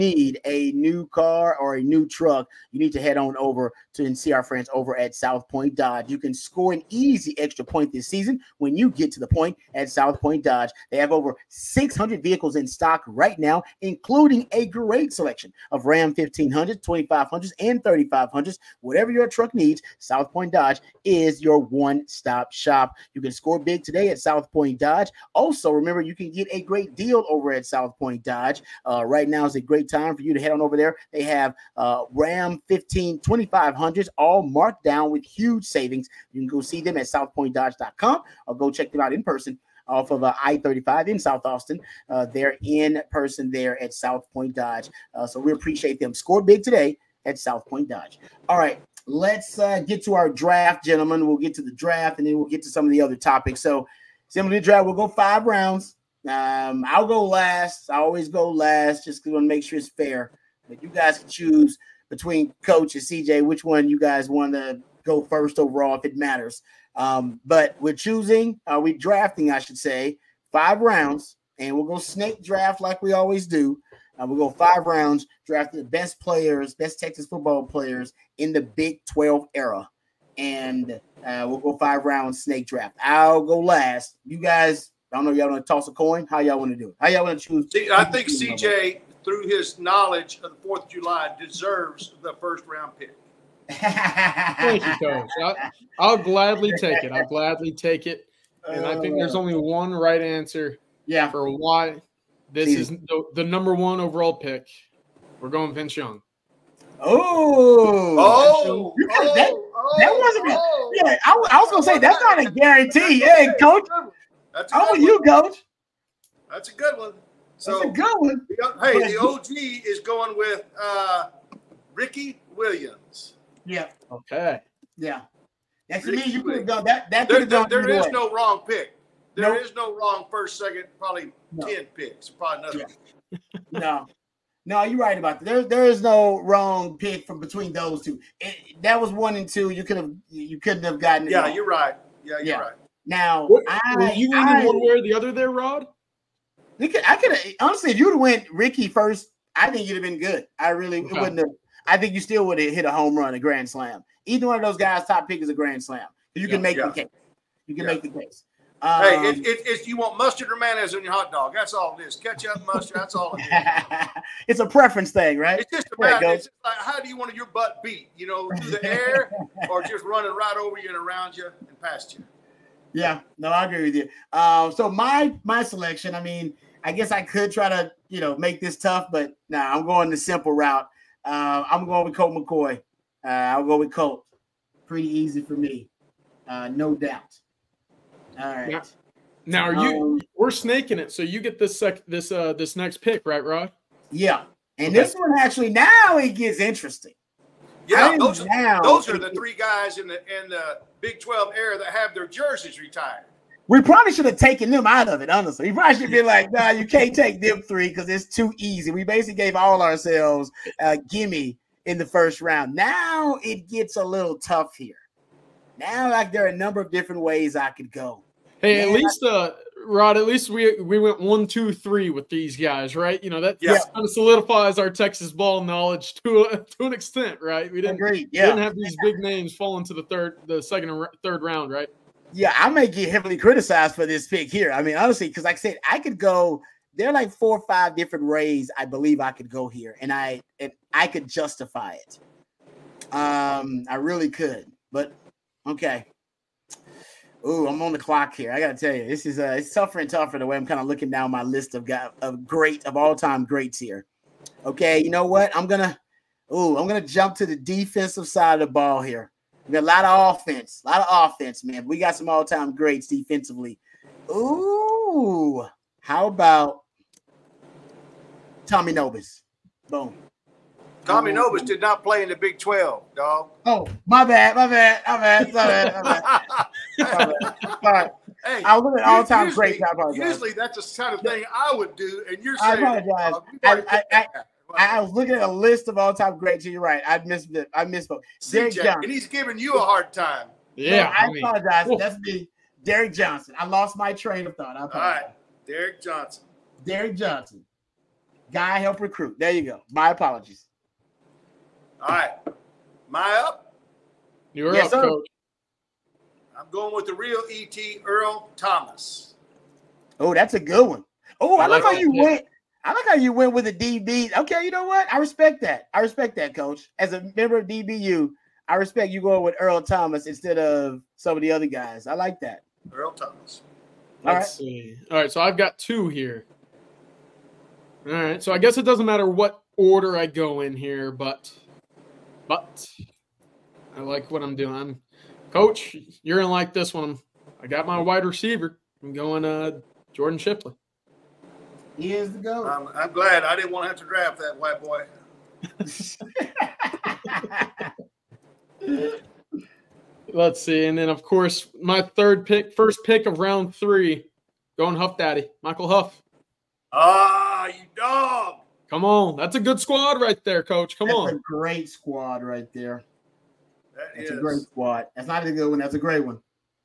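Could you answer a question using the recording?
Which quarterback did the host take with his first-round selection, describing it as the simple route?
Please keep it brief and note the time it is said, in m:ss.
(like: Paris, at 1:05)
Colt McCoy, at 3:02.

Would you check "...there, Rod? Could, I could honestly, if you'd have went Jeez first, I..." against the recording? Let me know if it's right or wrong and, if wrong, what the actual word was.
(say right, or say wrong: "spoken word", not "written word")
wrong: "Ricky", not "Jeez".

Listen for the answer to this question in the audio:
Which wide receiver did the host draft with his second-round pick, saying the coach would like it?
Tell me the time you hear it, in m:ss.
5:40.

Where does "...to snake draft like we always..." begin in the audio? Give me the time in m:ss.
1:11.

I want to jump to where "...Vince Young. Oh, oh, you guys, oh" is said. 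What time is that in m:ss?
1:45.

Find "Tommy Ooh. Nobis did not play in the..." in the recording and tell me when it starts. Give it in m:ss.
4:31.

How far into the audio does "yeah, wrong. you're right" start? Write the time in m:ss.
2:21.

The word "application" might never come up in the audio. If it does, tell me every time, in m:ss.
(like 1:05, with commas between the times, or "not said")
not said.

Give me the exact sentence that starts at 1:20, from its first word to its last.
And uh, we'll go five rounds snake draft.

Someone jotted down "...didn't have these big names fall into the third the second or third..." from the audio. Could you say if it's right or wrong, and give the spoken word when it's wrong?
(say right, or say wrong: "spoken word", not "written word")
right.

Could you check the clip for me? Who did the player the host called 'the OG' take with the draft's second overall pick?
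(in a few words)
Ricky Williams.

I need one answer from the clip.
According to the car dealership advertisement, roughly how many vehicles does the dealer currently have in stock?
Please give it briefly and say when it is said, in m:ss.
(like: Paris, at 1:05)
600, at 0:11.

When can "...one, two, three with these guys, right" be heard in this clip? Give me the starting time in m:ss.
3:41.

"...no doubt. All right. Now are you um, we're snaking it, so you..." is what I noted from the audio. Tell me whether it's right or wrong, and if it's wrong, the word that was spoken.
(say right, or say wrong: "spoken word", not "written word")
right.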